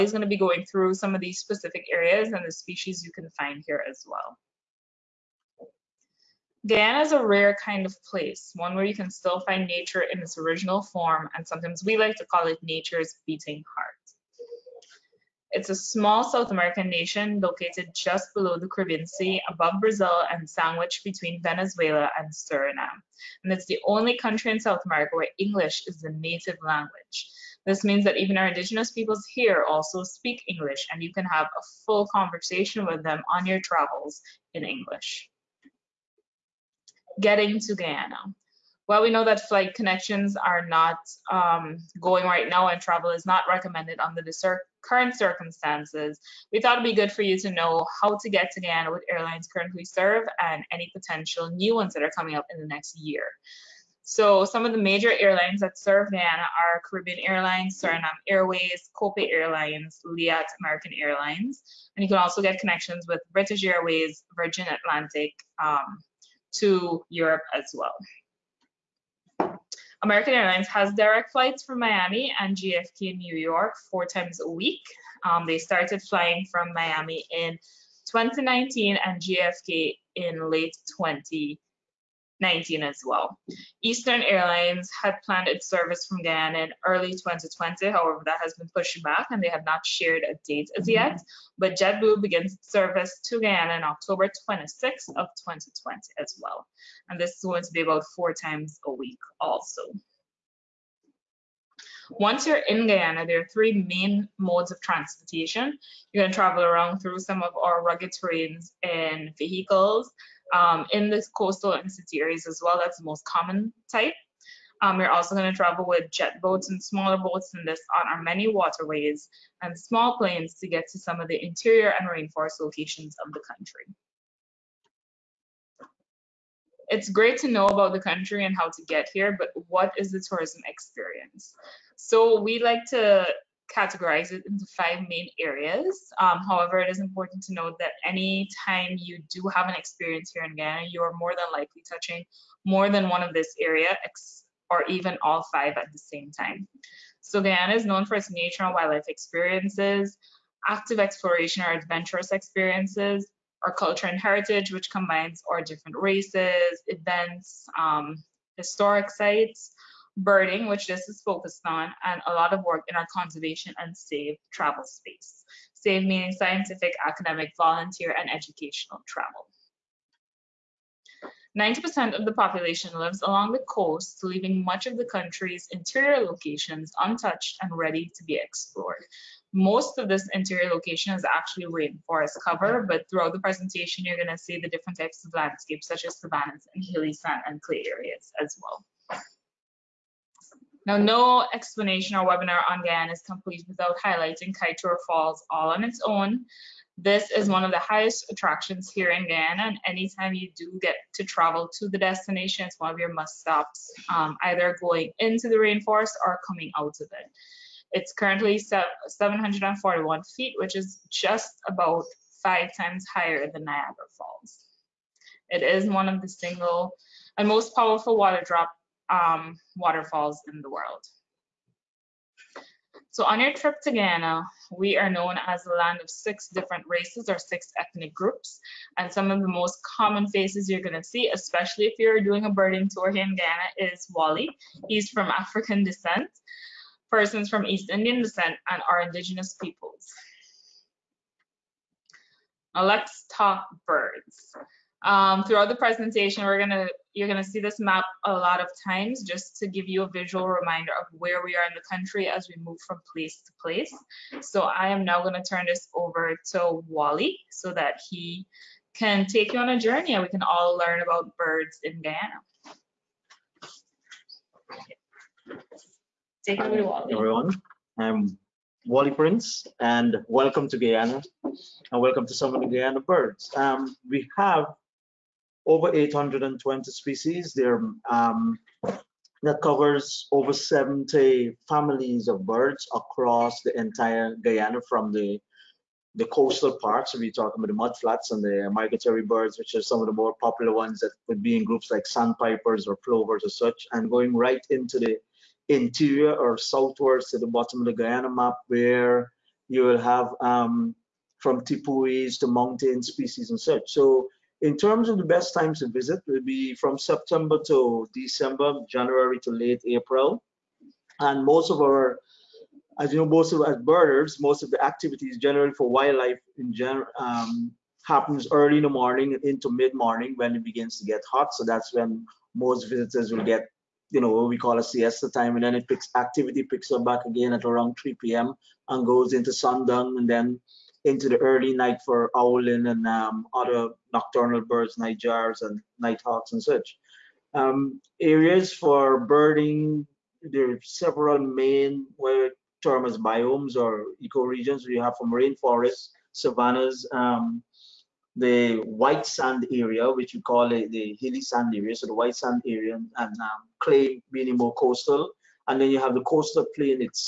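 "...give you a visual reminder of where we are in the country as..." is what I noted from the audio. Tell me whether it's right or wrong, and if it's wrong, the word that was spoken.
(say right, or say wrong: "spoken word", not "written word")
right.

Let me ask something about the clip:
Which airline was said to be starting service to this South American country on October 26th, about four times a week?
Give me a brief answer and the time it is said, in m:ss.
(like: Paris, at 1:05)
JetBlue, at 1:31.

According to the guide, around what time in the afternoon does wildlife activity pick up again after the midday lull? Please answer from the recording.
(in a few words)
3 p.m.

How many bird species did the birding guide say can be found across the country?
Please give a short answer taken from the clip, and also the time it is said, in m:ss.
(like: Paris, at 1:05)
820, at 4:35.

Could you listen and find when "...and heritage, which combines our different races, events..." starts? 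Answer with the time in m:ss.
2:34.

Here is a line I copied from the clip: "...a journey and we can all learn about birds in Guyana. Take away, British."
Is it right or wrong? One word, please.
wrong.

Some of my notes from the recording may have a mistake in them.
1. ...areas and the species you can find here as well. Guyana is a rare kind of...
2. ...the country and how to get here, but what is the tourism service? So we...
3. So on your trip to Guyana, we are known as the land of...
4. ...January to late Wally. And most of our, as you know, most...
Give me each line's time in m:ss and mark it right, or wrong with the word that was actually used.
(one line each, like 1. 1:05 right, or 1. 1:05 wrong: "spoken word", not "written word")
1. 0:01 right
2. 2:07 wrong: "experience", not "service"
3. 3:43 right
4. 5:08 wrong: "April", not "Wally".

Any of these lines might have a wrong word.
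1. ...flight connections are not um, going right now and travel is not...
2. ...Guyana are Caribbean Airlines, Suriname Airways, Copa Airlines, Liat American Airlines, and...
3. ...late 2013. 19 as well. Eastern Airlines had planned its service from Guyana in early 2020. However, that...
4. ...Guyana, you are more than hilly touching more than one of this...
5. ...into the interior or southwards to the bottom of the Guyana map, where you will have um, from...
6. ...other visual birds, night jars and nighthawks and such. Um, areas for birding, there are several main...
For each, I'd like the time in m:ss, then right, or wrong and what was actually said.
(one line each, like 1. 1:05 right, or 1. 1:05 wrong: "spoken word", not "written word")
1. 0:39 right
2. 0:56 right
3. 1:20 wrong: "2020", not "2013"
4. 2:20 wrong: "likely", not "hilly"
5. 4:54 right
6. 5:33 wrong: "nocturnal", not "visual".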